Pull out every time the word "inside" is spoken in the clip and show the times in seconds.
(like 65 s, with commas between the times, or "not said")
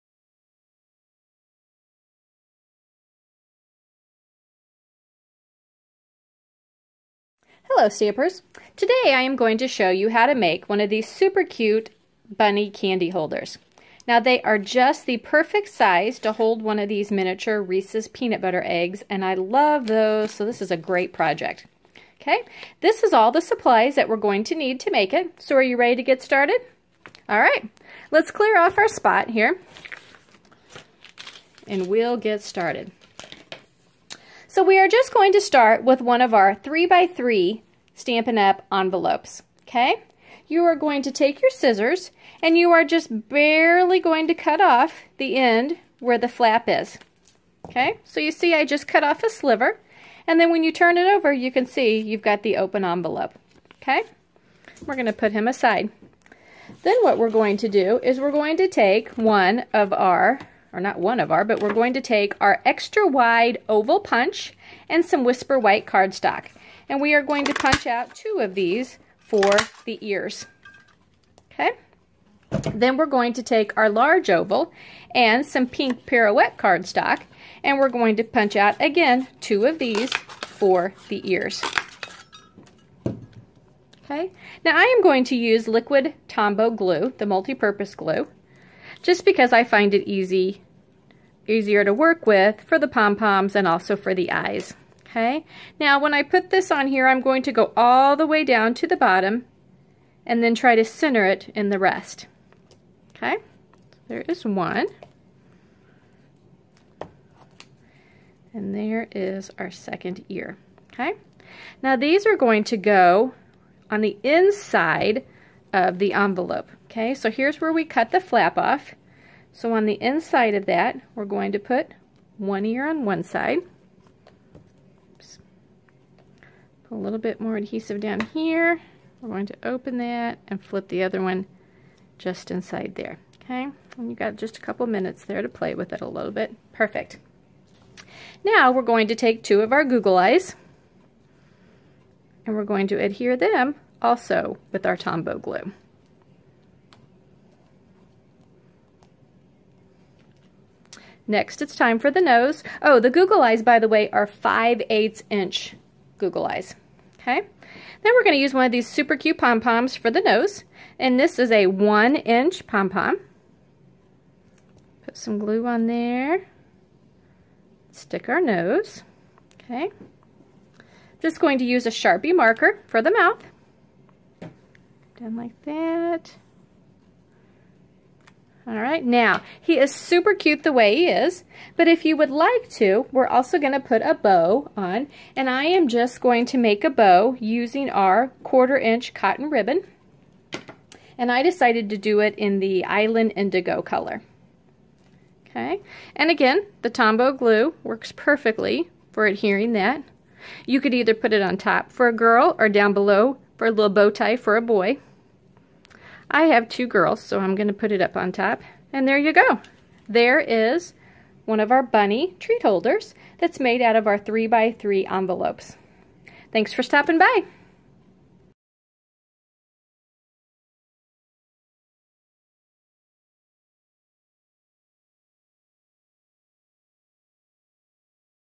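114 s, 120 s, 132 s.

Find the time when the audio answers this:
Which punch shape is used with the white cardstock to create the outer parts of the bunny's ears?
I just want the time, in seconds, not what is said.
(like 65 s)
62 s.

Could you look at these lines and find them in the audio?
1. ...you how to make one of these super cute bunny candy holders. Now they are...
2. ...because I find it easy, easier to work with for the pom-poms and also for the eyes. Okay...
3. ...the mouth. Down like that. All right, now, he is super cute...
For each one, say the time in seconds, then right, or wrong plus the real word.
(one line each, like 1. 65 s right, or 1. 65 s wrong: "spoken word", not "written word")
1. 9 s right
2. 89 s right
3. 173 s right.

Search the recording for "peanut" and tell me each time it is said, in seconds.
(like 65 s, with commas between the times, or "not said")
18 s.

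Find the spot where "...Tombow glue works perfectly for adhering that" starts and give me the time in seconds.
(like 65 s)
196 s.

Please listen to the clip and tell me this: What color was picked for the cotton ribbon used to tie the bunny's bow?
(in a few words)
Island Indigo.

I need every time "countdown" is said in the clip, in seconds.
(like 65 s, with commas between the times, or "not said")
not said.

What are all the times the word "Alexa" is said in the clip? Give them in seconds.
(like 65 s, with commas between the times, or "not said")
not said.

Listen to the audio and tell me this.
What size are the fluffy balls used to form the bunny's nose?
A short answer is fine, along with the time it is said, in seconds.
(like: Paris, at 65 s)
1 inch, at 161 s.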